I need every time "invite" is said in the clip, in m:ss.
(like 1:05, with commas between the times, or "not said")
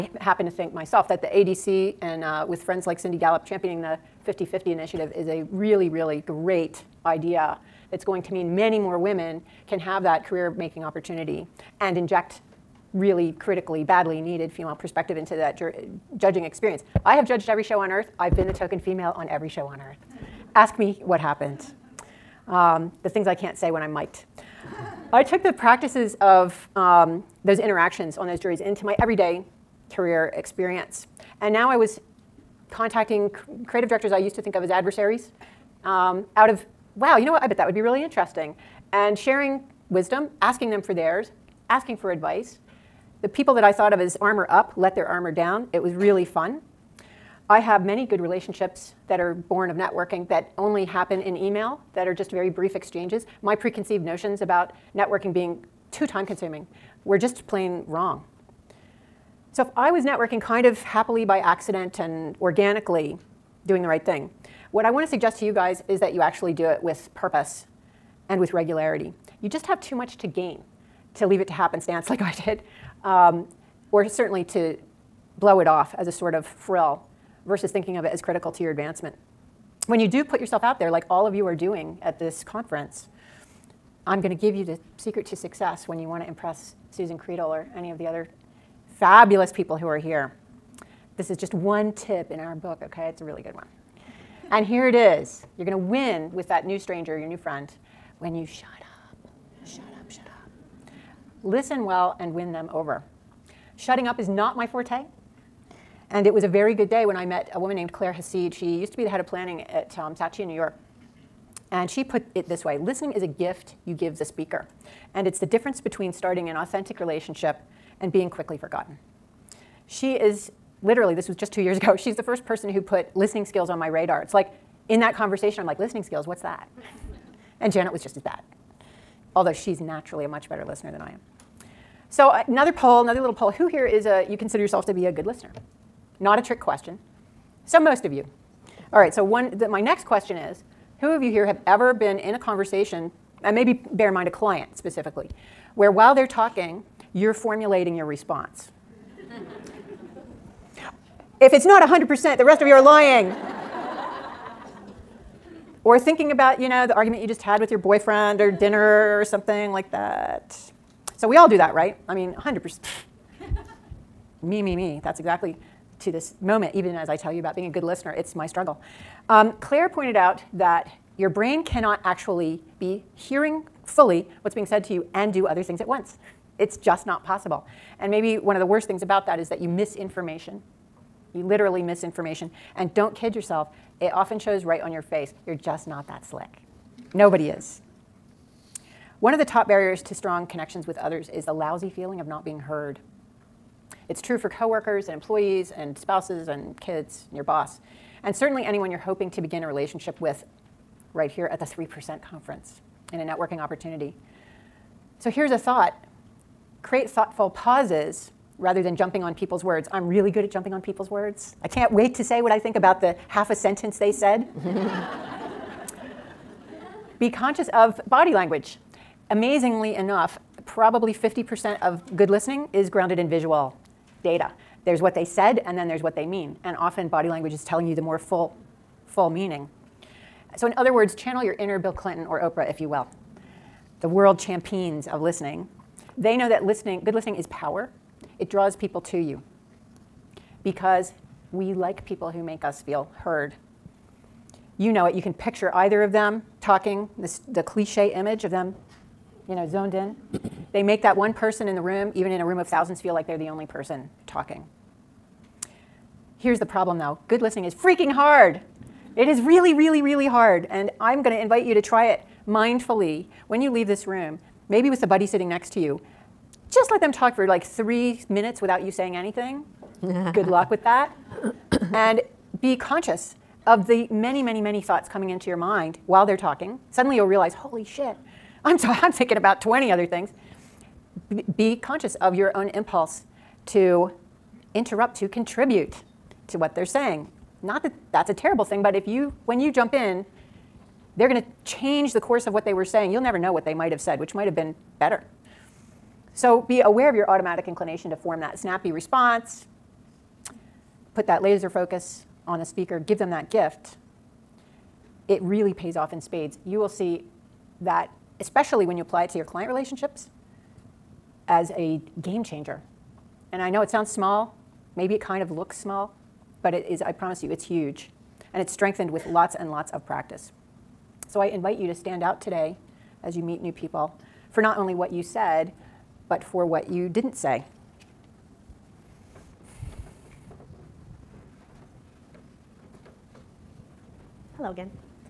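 4:21, 5:21.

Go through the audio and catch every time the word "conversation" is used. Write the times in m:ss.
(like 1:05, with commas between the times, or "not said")
2:05, 2:22.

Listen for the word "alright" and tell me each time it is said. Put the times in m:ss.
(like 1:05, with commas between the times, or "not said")
not said.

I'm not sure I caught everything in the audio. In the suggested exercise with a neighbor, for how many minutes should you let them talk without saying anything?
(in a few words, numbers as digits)
3 minutes.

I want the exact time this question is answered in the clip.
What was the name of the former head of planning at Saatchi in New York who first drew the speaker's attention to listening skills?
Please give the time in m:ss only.
1:47.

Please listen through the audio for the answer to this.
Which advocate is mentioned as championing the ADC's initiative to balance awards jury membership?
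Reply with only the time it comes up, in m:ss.
0:02.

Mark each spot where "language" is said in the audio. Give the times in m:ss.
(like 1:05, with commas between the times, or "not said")
3:38, 3:47.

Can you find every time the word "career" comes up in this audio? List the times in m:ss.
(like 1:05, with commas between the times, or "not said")
0:10, 0:29.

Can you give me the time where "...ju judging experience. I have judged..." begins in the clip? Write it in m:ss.
0:15.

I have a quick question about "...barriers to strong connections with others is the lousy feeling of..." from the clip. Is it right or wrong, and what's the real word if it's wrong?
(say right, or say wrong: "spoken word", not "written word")
right.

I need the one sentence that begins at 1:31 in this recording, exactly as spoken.
This is just one tip in our book, okay?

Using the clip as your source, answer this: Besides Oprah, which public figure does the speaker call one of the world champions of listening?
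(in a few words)
Bill Clinton.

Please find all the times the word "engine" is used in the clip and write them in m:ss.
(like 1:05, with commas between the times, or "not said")
not said.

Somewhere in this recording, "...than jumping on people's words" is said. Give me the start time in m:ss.
3:28.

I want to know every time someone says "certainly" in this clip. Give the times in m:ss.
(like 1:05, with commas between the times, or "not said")
1:14, 3:18.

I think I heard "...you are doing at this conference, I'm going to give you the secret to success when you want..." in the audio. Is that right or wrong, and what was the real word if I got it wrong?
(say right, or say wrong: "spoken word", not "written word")
right.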